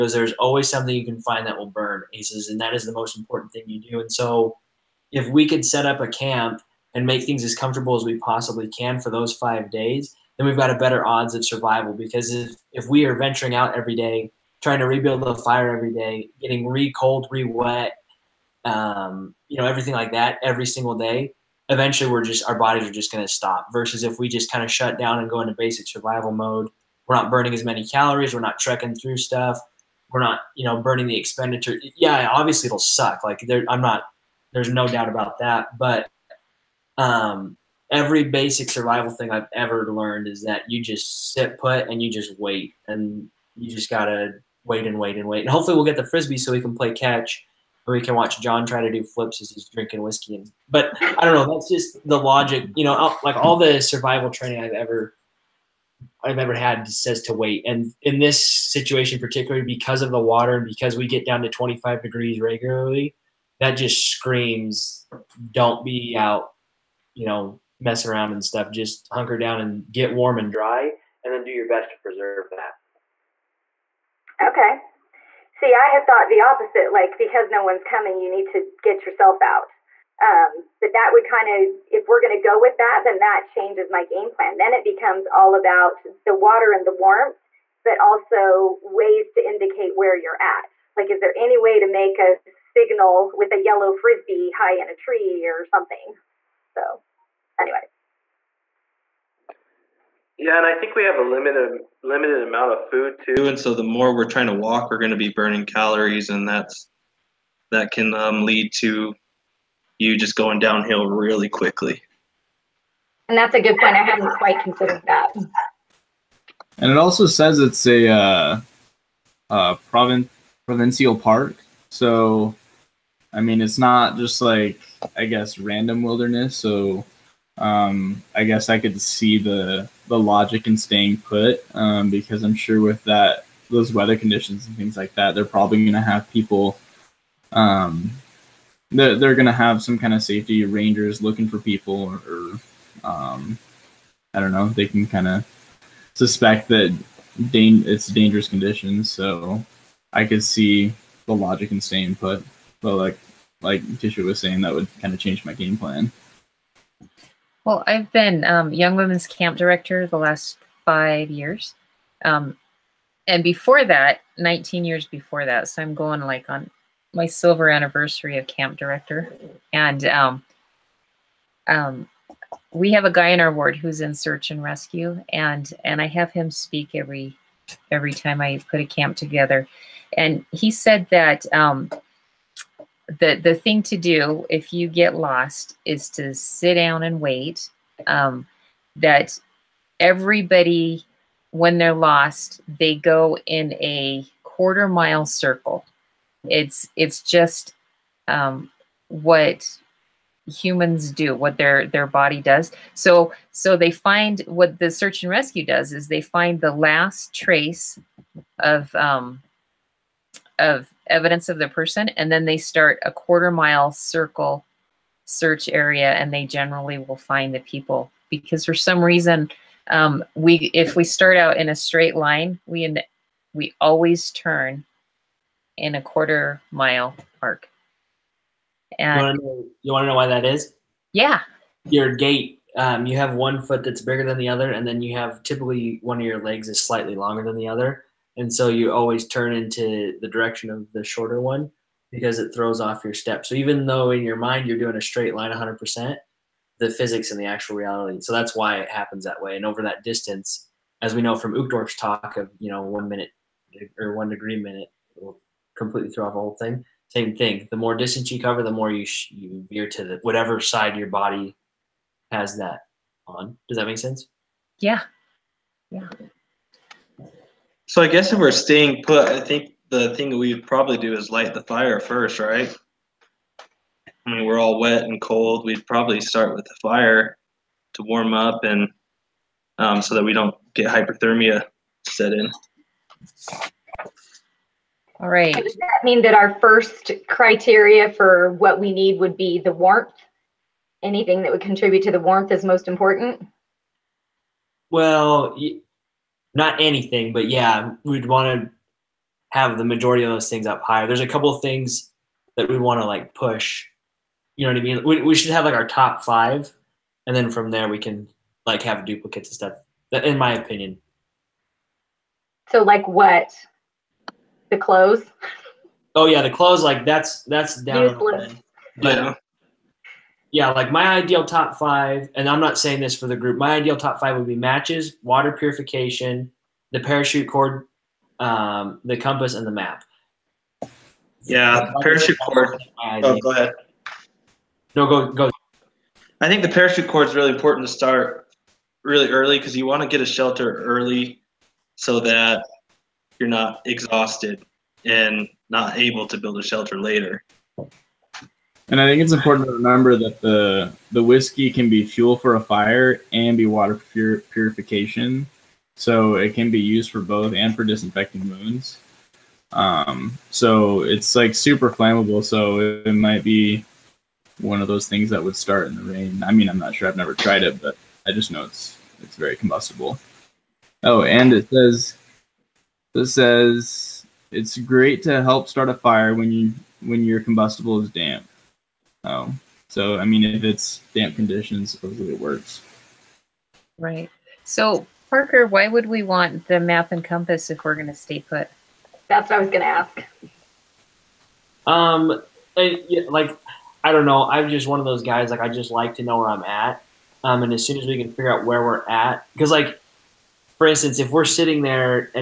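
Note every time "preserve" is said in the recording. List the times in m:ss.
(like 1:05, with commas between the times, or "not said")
1:12.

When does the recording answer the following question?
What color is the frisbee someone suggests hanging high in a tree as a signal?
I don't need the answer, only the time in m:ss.
1:33.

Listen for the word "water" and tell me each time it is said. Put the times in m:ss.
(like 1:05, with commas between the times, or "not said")
1:00, 1:26, 5:25, 5:53.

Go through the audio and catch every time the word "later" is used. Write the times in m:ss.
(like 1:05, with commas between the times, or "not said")
5:46.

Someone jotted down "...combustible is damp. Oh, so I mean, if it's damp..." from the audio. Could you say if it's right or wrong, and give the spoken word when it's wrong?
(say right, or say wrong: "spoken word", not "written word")
right.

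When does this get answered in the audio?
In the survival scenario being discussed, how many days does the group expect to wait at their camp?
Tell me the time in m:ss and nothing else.
0:09.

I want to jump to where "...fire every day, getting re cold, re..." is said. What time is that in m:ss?
0:15.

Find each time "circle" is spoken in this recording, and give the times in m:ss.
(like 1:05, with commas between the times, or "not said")
3:15, 3:33.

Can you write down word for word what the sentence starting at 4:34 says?
I mean, we're all wet and cold.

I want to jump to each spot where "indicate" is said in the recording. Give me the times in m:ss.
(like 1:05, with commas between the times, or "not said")
1:29.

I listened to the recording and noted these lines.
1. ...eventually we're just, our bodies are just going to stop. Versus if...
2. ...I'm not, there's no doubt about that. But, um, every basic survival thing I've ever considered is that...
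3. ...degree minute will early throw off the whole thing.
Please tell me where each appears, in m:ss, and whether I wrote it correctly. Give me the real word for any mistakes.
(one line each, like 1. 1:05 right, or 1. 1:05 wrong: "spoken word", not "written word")
1. 0:21 right
2. 0:33 wrong: "learned", not "considered"
3. 4:14 wrong: "completely", not "early".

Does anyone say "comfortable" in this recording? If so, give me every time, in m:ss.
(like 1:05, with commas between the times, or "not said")
0:07.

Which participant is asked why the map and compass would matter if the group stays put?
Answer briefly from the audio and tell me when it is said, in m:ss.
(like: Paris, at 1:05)
Parker, at 6:25.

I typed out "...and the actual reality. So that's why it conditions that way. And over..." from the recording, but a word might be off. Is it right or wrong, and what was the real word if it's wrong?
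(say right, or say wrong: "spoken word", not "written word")
wrong: "happens", not "conditions".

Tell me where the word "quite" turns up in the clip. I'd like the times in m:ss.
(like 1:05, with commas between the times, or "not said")
1:54.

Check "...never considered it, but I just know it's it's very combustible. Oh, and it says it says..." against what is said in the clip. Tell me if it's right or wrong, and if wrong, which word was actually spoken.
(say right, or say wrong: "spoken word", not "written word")
wrong: "tried", not "considered".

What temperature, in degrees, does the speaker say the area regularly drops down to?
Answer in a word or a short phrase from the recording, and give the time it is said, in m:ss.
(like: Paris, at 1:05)
25, at 1:01.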